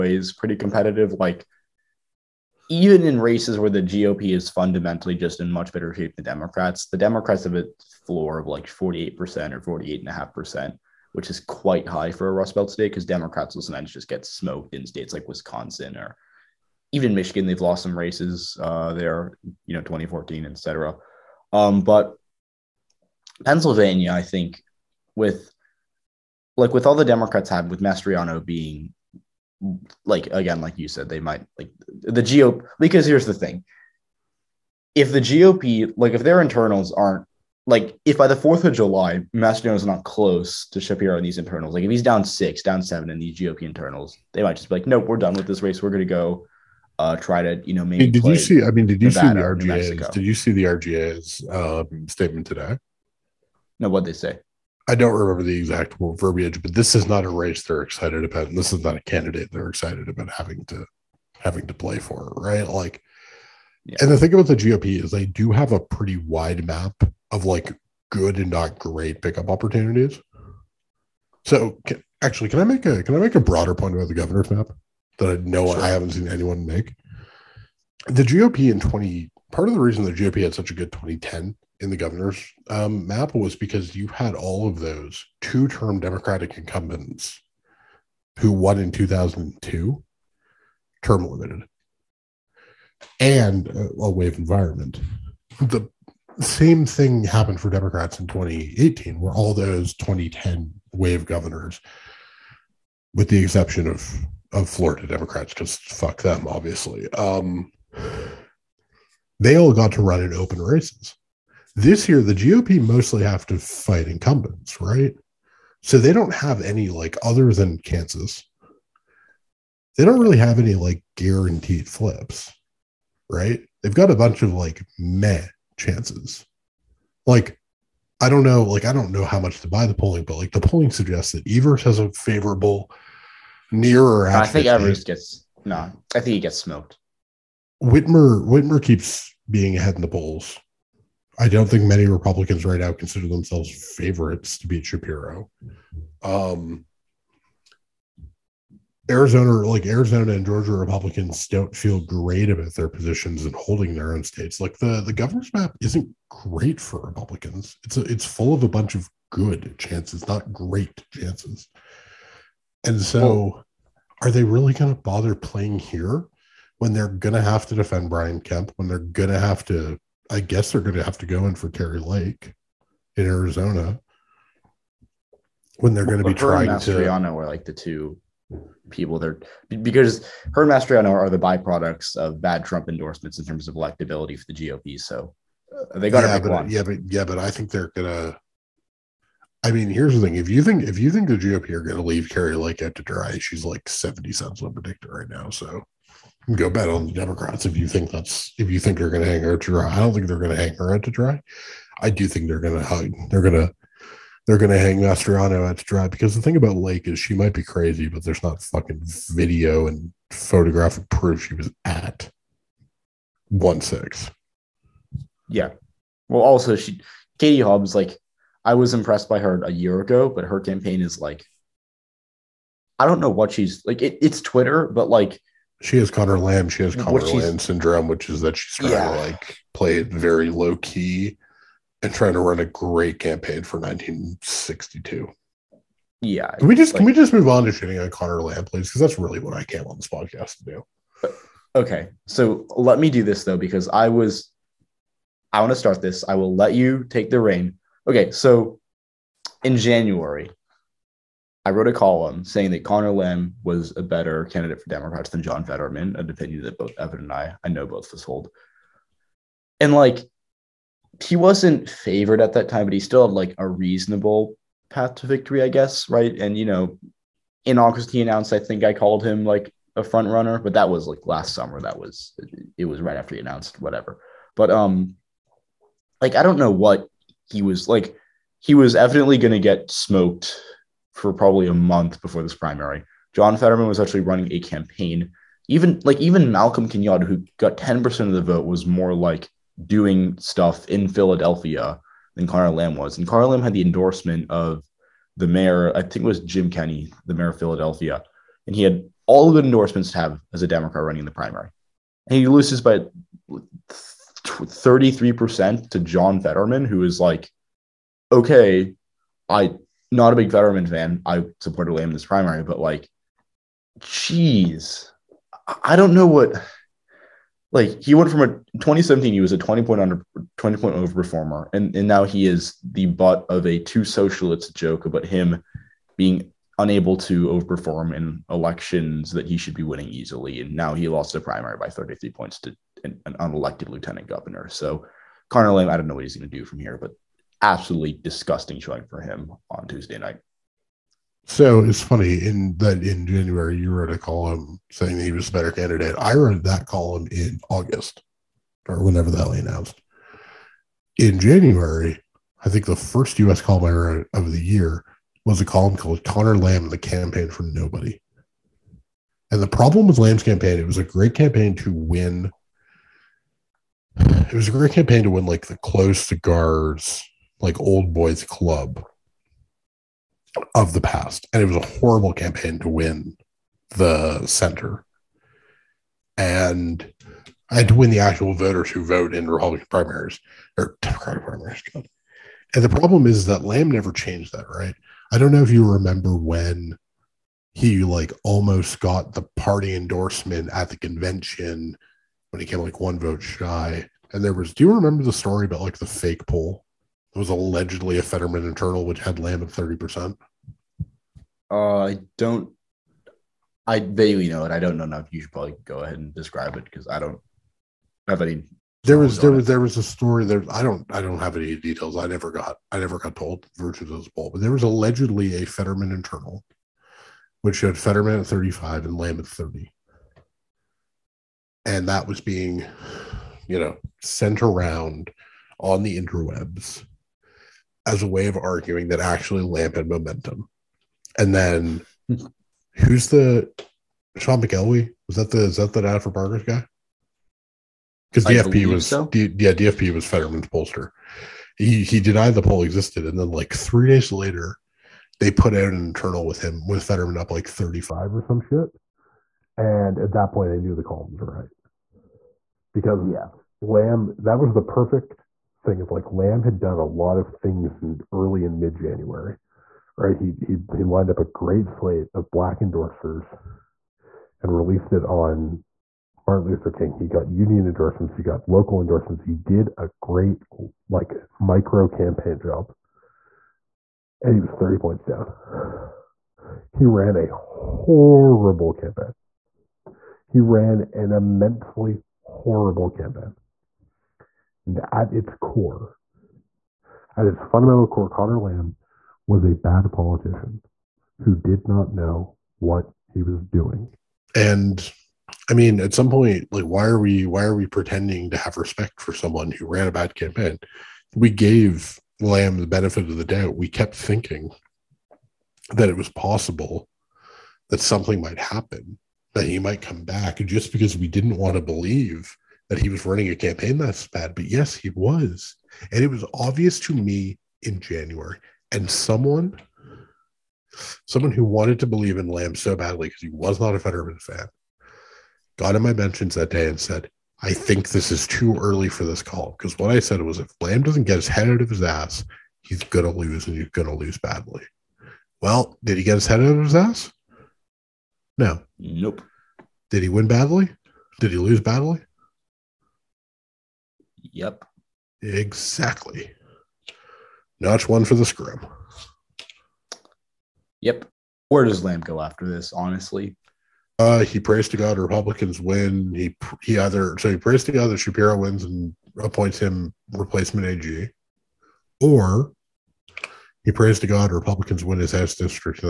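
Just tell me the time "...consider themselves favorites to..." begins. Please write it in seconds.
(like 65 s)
142 s.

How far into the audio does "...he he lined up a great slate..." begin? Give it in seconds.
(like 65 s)
460 s.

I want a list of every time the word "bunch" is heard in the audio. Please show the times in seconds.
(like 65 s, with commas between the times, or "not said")
124 s, 158 s.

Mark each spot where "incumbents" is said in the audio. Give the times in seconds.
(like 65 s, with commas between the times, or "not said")
86 s, 114 s.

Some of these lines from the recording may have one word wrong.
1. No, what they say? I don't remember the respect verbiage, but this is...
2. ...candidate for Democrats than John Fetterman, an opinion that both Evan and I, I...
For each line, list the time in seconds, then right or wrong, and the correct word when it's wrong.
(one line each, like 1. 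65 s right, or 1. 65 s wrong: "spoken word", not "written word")
1. 53 s wrong: "exact", not "respect"
2. 254 s right.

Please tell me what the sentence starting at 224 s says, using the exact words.
It, it's Twitter, but like she has Conor Lamb.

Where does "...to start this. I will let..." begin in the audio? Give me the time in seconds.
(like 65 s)
245 s.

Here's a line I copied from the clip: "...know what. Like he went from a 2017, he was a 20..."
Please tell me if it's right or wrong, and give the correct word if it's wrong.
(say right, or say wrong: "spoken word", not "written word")
right.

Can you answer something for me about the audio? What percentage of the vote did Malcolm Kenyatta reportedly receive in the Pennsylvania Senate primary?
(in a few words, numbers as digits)
10%.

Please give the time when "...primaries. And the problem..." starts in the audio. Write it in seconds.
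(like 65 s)
381 s.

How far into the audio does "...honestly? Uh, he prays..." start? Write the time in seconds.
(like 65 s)
552 s.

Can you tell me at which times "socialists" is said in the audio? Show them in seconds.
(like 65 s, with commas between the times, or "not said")
324 s.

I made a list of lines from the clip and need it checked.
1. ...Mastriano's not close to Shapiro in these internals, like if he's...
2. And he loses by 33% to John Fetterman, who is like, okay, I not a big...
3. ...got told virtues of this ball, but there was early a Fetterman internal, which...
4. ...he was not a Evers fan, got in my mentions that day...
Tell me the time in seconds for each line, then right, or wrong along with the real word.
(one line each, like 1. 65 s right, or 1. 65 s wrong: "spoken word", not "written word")
1. 39 s right
2. 302 s right
3. 413 s wrong: "allegedly", not "early"
4. 523 s wrong: "Fetterman", not "Evers".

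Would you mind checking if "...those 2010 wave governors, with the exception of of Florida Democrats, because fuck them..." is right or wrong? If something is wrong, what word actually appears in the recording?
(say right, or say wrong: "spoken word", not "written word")
right.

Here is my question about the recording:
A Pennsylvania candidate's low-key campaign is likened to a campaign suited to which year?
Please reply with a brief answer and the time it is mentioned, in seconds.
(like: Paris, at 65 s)
1962, at 233 s.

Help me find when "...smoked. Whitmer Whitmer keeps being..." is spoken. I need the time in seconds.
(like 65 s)
136 s.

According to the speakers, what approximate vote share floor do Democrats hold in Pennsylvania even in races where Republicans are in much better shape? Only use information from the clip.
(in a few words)
48%.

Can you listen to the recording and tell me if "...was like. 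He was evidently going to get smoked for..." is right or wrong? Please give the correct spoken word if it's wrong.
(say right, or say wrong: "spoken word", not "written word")
right.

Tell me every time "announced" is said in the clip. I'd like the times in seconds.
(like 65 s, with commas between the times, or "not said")
268 s, 273 s, 349 s.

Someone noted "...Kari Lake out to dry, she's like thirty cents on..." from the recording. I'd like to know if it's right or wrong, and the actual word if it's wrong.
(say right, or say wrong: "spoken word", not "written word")
wrong: "seventy", not "thirty".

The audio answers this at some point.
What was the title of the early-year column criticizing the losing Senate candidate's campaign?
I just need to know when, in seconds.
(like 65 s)
356 s.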